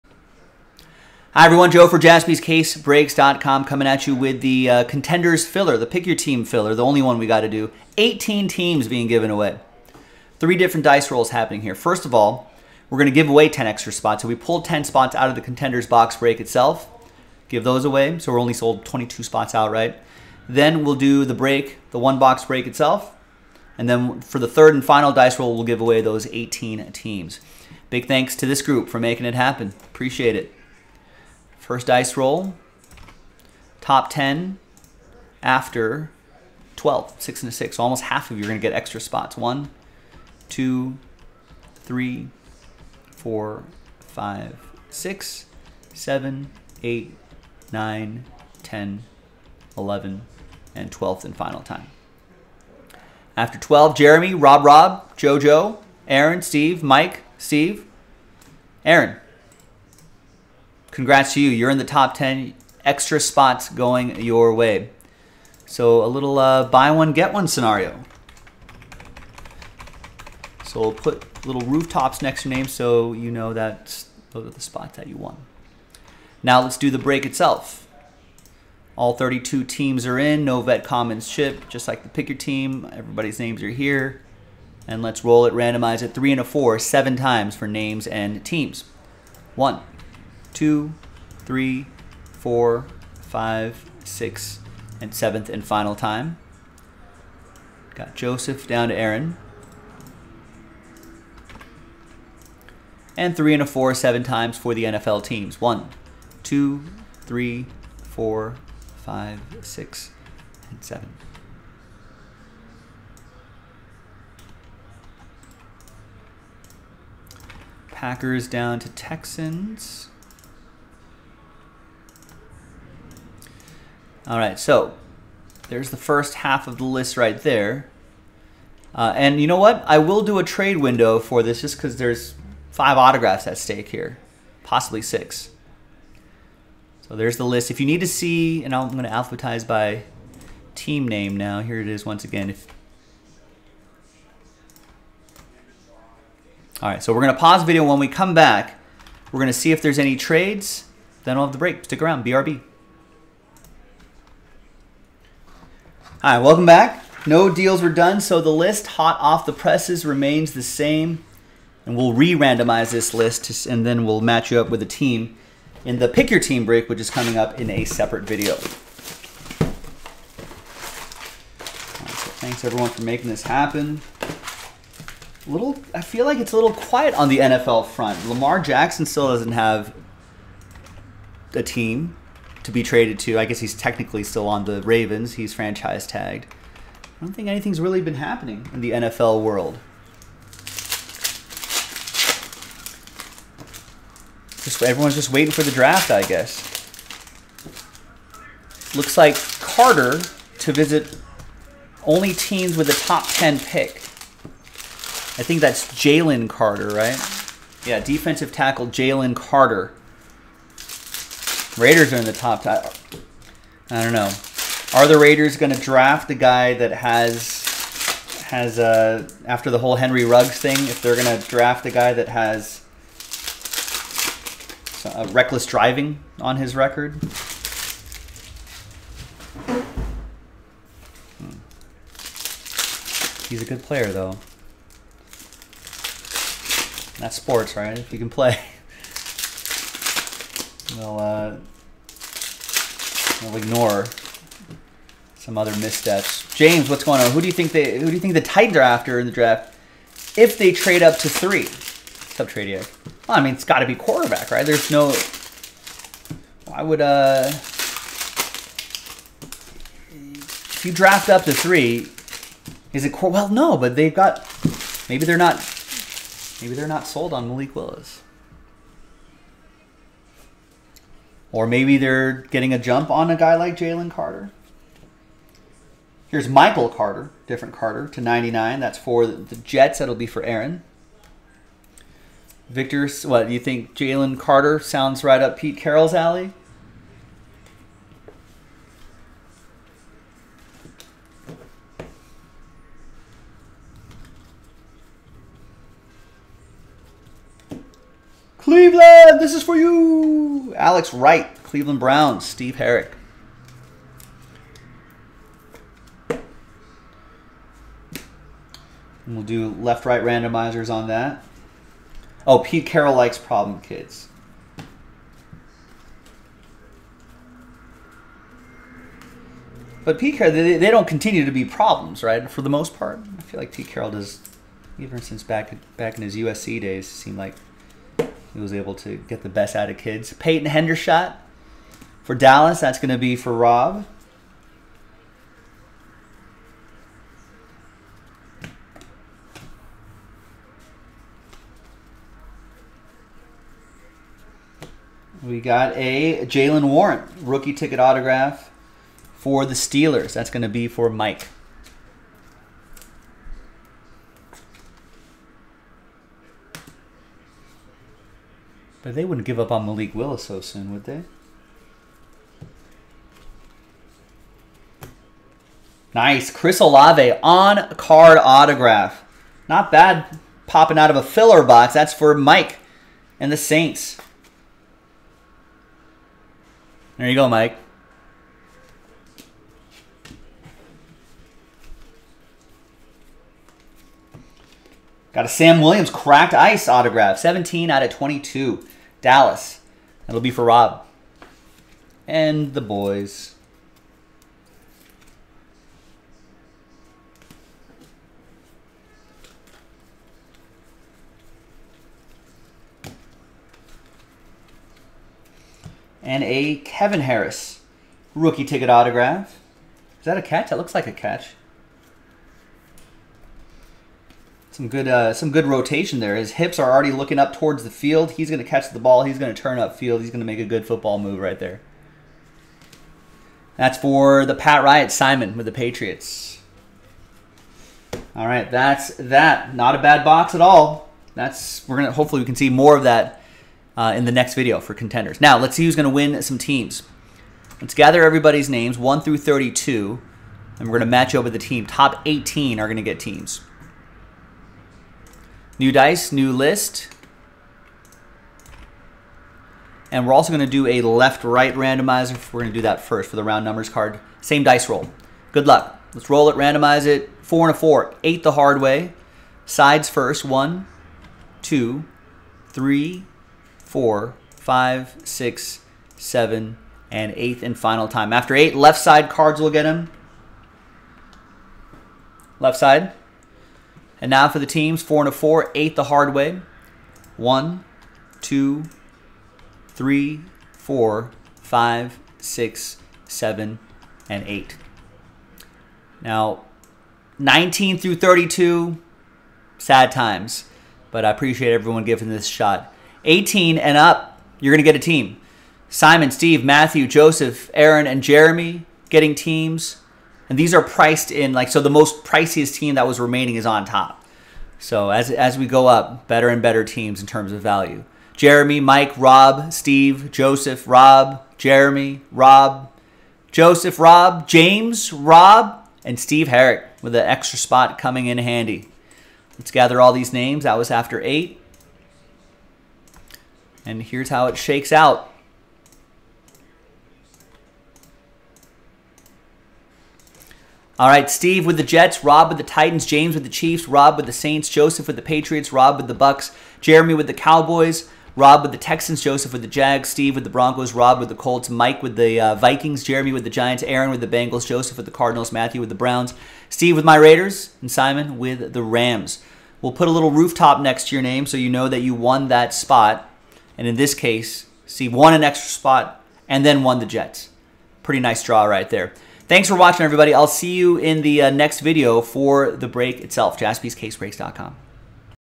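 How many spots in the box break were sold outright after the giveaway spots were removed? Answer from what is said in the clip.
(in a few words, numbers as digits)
22.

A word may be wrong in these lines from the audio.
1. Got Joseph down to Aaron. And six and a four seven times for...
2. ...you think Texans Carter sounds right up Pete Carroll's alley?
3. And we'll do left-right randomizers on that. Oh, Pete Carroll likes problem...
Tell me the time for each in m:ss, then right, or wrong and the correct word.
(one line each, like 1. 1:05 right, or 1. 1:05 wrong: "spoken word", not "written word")
1. 1:37 wrong: "three", not "six"
2. 4:43 wrong: "Jalen", not "Texans"
3. 5:06 right.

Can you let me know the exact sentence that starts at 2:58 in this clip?
Lamar Jackson still doesn't have a team to be traded to.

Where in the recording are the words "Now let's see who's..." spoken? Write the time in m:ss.
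7:15.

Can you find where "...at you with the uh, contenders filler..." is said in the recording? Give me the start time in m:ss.
0:03.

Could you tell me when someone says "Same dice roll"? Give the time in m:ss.
7:34.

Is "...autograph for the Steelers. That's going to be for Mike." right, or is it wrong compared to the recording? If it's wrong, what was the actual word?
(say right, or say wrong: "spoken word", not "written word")
right.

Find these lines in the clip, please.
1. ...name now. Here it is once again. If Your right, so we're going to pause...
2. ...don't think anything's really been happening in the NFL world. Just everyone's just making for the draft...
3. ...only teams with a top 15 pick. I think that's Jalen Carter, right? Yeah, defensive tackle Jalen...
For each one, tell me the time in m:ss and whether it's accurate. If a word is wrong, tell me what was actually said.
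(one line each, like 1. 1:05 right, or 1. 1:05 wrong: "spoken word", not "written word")
1. 2:21 wrong: "All", not "Your"
2. 3:07 wrong: "waiting", not "making"
3. 3:22 wrong: "10", not "15".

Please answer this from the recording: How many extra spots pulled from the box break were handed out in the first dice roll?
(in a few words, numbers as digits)
10.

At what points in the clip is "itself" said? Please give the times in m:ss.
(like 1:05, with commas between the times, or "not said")
0:16, 0:22, 1:17, 9:23.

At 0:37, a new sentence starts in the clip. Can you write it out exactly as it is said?
So almost half of you are gonna get extra spots.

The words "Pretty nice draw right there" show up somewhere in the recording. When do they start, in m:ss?
9:18.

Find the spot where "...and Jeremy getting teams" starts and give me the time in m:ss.
8:18.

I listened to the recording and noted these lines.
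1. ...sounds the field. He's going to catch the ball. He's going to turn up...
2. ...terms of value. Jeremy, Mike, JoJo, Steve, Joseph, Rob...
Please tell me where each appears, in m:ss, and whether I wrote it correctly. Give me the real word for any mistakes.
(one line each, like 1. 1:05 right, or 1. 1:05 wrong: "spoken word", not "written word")
1. 6:57 wrong: "towards", not "sounds"
2. 8:27 wrong: "Rob", not "JoJo".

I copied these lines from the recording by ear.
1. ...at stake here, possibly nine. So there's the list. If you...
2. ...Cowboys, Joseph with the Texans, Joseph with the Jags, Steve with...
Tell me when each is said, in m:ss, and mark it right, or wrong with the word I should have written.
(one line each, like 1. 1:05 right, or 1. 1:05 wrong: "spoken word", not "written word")
1. 2:13 wrong: "six", not "nine"
2. 8:57 wrong: "Rob", not "Joseph".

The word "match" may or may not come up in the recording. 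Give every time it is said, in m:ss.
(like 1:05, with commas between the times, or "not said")
2:44, 7:21.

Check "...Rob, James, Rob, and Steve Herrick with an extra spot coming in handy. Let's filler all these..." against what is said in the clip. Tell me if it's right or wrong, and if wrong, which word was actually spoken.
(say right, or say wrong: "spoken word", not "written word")
wrong: "gather", not "filler".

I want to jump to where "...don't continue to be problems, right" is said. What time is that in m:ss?
5:20.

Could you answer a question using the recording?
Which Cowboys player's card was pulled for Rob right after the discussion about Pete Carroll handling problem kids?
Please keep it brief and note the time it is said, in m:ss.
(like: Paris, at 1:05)
Peyton Hendershot, at 5:30.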